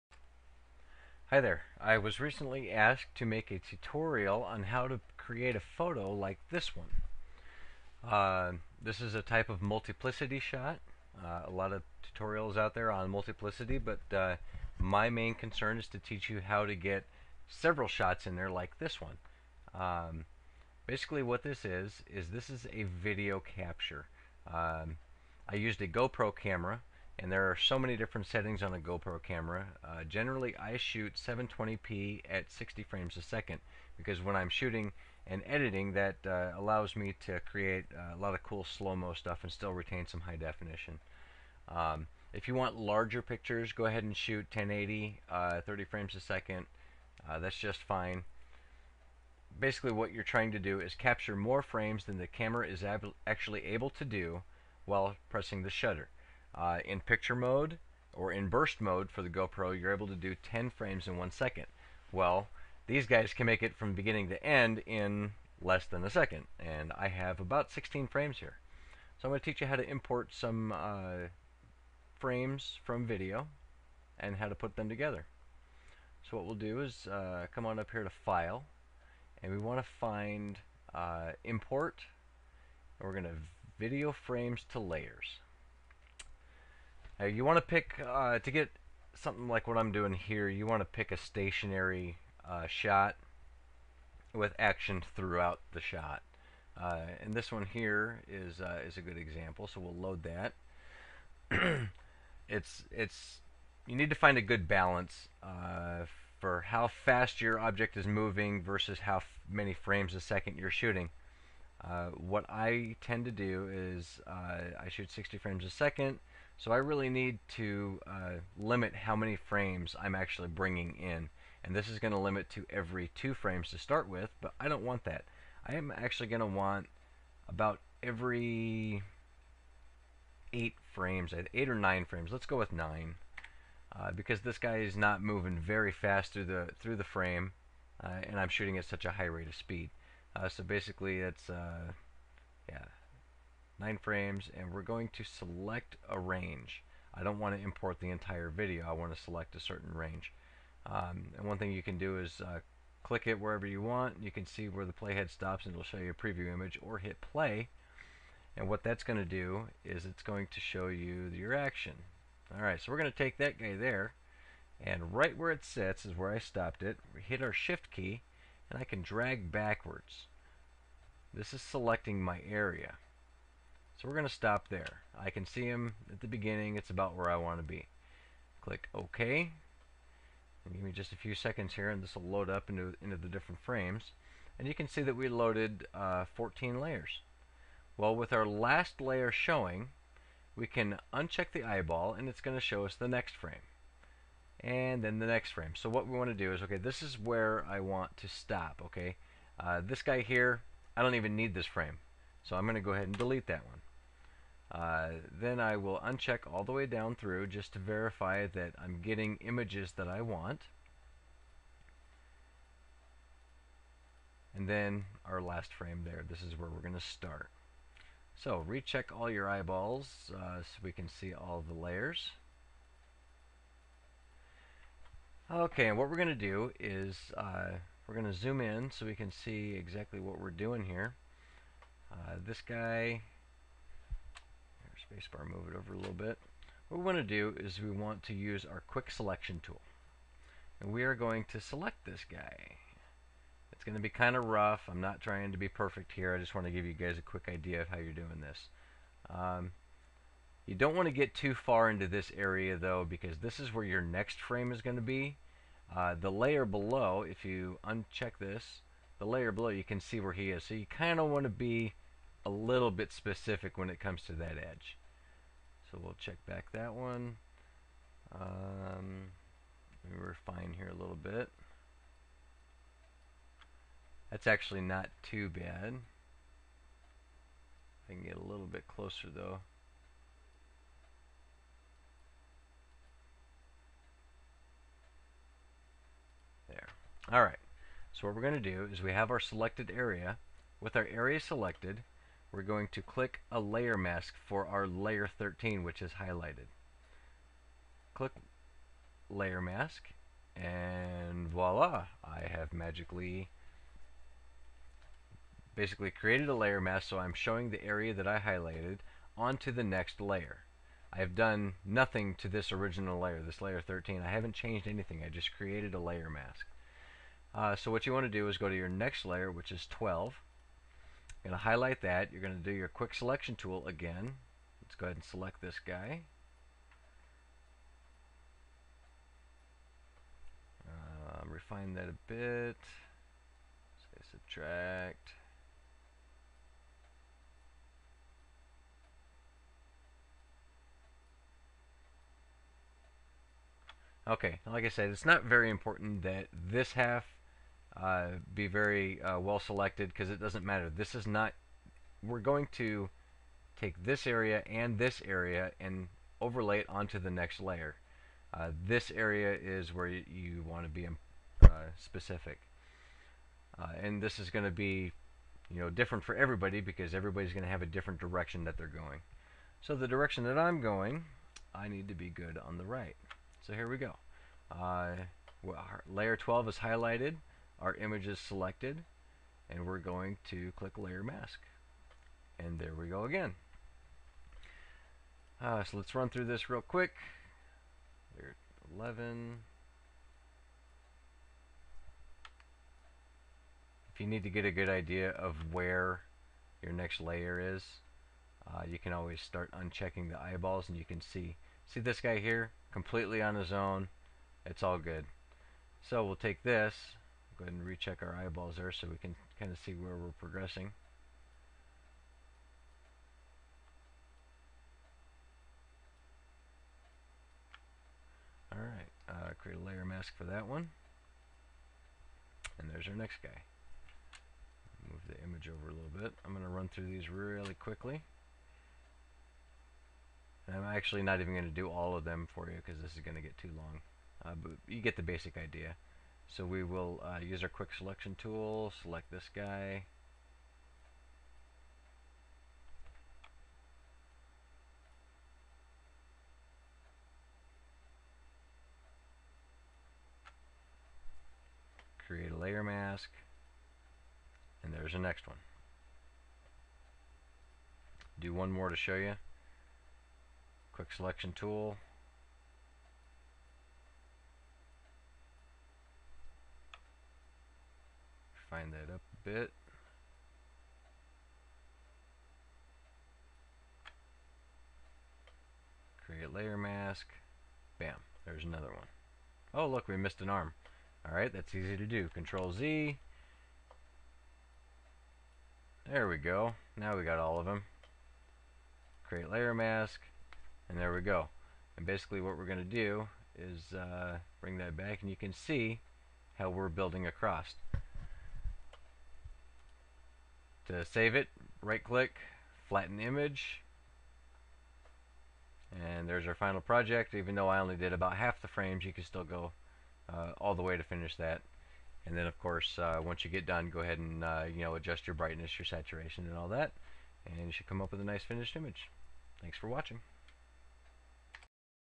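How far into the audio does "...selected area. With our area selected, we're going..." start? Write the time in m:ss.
4:49.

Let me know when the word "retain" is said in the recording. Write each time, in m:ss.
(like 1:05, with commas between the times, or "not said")
0:39.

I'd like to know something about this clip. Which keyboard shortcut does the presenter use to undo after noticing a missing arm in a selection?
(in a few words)
Control Z.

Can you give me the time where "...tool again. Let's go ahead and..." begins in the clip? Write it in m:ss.
5:23.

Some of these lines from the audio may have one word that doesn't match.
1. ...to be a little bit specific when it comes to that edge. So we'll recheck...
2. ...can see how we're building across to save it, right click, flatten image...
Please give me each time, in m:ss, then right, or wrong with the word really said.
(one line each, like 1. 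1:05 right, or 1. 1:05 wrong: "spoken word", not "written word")
1. 4:21 wrong: "check", not "recheck"
2. 8:15 right.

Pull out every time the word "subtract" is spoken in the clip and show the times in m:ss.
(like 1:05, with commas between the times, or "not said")
5:34.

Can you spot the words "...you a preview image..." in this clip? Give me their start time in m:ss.
2:35.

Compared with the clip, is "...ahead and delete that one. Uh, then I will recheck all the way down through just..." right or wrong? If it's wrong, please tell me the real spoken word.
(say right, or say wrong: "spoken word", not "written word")
wrong: "uncheck", not "recheck".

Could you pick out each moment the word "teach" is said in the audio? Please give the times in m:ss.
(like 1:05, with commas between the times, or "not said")
0:15, 1:09.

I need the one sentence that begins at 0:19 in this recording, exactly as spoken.
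Um, basically what this is, is this is a video capture.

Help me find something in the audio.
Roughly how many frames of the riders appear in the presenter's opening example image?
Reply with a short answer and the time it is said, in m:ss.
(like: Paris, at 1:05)
16, at 1:07.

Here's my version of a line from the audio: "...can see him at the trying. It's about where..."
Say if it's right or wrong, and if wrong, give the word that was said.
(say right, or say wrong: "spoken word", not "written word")
wrong: "beginning", not "trying".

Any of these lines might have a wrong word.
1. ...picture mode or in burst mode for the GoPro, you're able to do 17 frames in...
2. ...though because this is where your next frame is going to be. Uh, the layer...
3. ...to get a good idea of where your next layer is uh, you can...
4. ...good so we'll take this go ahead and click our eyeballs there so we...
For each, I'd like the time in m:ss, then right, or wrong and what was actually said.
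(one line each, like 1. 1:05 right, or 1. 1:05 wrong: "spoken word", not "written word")
1. 0:56 wrong: "10", not "17"
2. 4:12 right
3. 6:34 right
4. 6:44 wrong: "recheck", not "click".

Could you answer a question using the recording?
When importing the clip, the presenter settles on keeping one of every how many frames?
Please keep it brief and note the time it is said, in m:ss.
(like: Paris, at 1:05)
9, at 2:12.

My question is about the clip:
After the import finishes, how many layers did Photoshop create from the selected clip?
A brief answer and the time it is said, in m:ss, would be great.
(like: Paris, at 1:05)
14, at 3:06.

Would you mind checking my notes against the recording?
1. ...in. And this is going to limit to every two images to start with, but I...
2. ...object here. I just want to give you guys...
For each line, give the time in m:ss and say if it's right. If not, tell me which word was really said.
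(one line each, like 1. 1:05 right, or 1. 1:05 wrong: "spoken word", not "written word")
1. 2:00 wrong: "frames", not "images"
2. 4:05 wrong: "perfect", not "object".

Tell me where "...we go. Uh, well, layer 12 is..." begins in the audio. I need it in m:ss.
6:13.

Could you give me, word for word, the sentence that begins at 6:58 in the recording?
Alright, uh, create a layer mask for that one.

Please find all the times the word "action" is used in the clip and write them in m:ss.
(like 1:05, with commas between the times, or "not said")
1:34, 2:41.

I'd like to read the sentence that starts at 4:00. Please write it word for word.
And we are going to select this guy.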